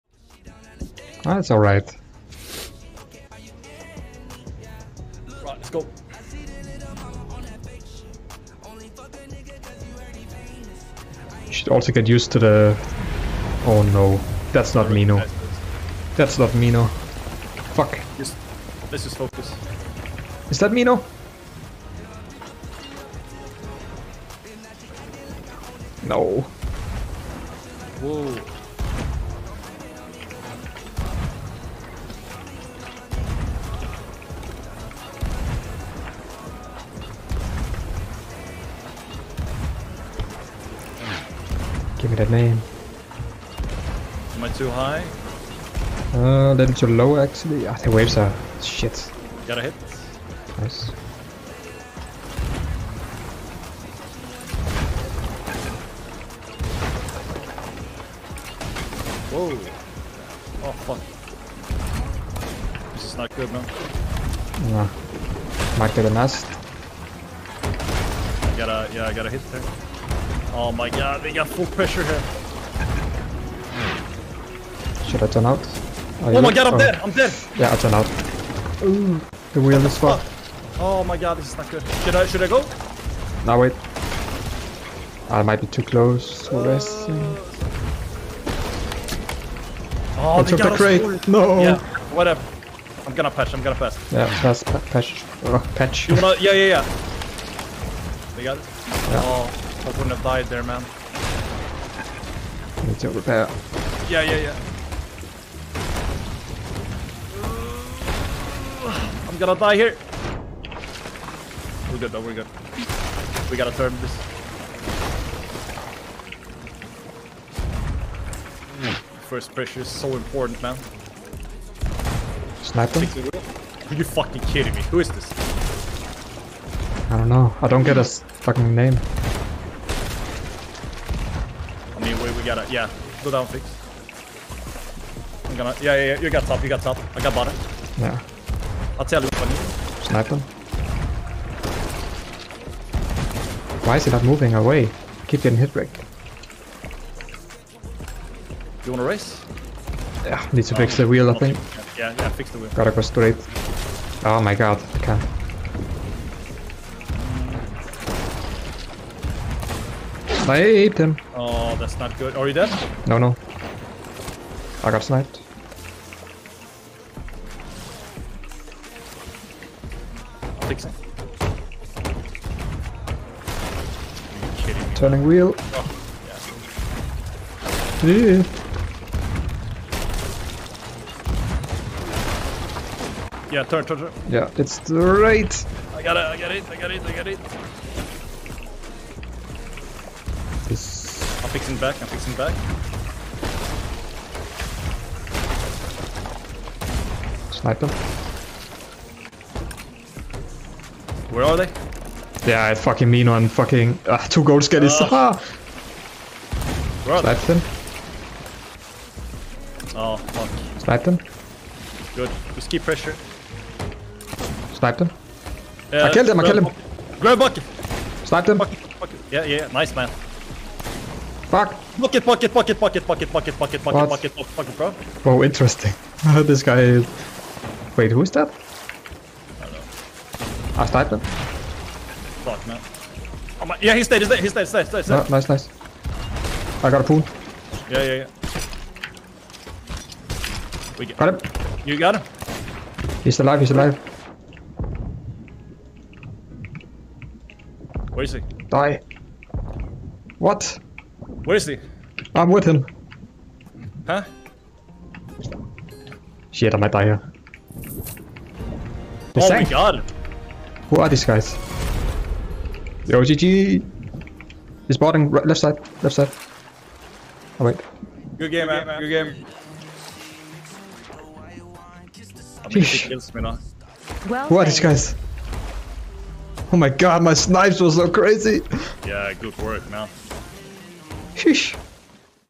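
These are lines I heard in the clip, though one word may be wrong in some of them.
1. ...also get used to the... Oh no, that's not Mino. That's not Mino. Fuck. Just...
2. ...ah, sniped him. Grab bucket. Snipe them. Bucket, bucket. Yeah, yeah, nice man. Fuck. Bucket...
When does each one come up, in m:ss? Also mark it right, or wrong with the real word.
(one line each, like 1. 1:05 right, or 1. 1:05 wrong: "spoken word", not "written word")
1. 0:11 right
2. 3:36 wrong: "killed", not "sniped".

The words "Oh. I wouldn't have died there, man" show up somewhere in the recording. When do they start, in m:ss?
1:39.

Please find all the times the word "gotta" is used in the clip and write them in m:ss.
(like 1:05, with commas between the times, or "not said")
1:53, 2:32.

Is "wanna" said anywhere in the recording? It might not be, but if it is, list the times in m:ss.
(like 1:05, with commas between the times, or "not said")
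1:36, 2:28.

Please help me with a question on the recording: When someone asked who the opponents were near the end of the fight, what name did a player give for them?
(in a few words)
The OGG.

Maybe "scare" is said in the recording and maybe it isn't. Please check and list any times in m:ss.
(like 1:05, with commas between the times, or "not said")
not said.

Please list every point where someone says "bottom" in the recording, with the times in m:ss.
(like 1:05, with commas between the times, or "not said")
2:17.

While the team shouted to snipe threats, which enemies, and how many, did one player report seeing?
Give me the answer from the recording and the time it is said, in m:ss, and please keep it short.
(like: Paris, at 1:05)
2 gold skellies, at 3:24.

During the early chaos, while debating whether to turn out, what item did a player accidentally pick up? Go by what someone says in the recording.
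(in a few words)
the crate.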